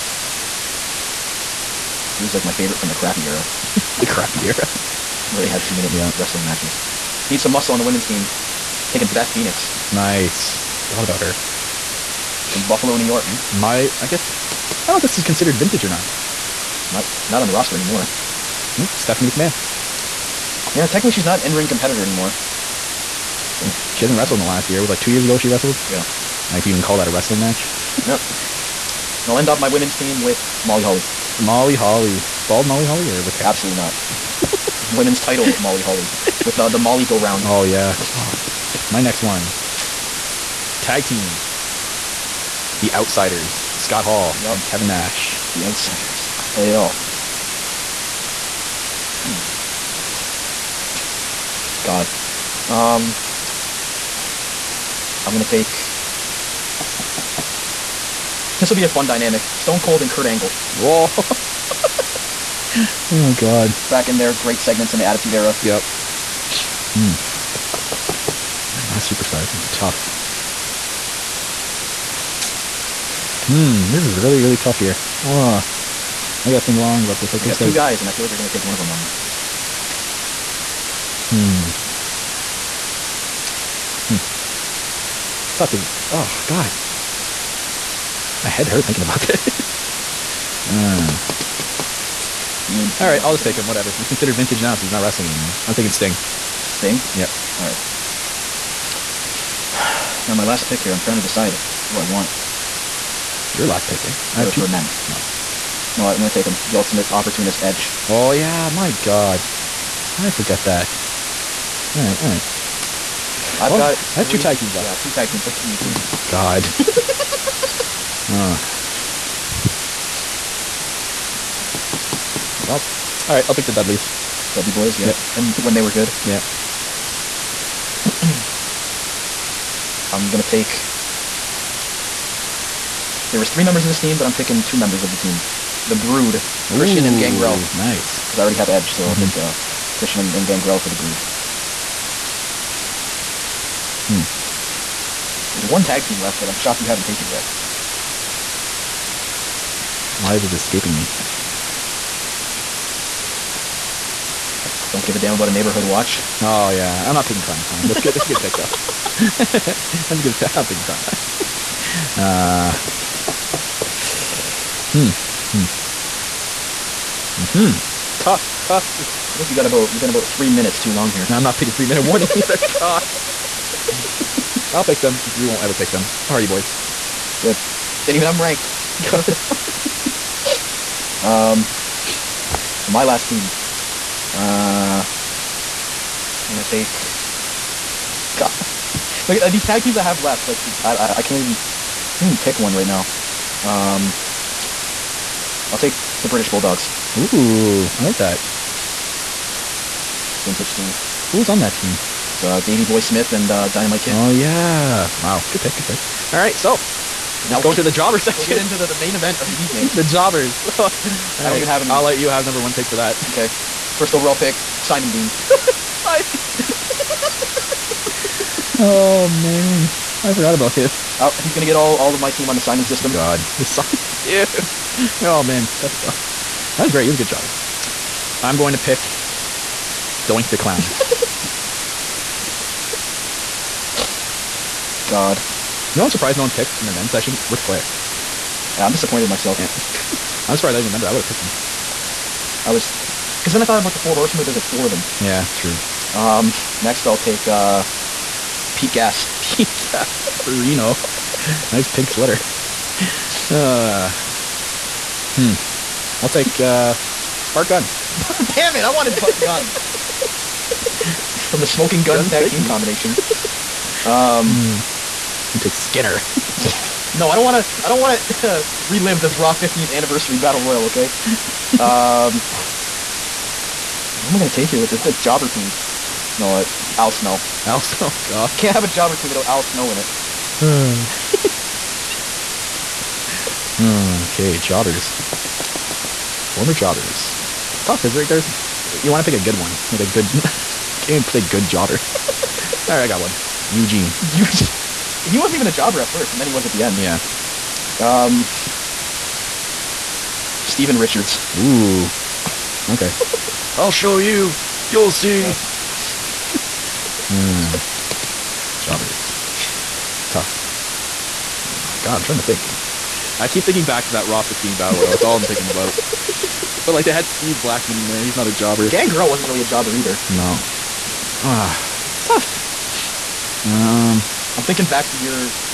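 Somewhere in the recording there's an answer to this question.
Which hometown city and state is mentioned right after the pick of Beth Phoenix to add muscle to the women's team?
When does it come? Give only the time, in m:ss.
0:12.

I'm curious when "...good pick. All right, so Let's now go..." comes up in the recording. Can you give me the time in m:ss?
3:25.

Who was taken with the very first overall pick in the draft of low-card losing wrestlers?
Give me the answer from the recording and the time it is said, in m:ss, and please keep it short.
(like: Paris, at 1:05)
Simon Dean, at 3:34.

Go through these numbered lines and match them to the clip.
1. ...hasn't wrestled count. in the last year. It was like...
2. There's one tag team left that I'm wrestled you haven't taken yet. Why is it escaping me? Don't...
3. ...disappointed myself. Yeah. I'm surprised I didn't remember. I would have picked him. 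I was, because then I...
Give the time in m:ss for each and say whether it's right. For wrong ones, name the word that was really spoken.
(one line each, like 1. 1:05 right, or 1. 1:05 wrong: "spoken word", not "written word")
1. 0:24 right
2. 2:25 wrong: "shocked", not "wrestled"
3. 3:58 right.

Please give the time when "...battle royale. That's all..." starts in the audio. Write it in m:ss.
5:14.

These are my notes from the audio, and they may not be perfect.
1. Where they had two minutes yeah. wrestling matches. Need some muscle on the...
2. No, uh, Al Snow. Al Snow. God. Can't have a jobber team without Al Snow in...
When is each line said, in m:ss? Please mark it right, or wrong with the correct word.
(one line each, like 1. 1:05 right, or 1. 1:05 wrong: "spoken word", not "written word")
1. 0:05 right
2. 4:36 right.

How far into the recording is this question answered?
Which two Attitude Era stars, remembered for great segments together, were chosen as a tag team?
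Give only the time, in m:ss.
0:59.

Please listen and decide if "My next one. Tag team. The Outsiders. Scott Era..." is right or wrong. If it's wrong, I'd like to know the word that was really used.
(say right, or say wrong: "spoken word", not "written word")
wrong: "Hall", not "Era".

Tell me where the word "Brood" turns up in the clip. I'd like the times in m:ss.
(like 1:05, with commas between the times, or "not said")
2:15, 2:20.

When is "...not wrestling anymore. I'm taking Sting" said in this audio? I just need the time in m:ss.
1:34.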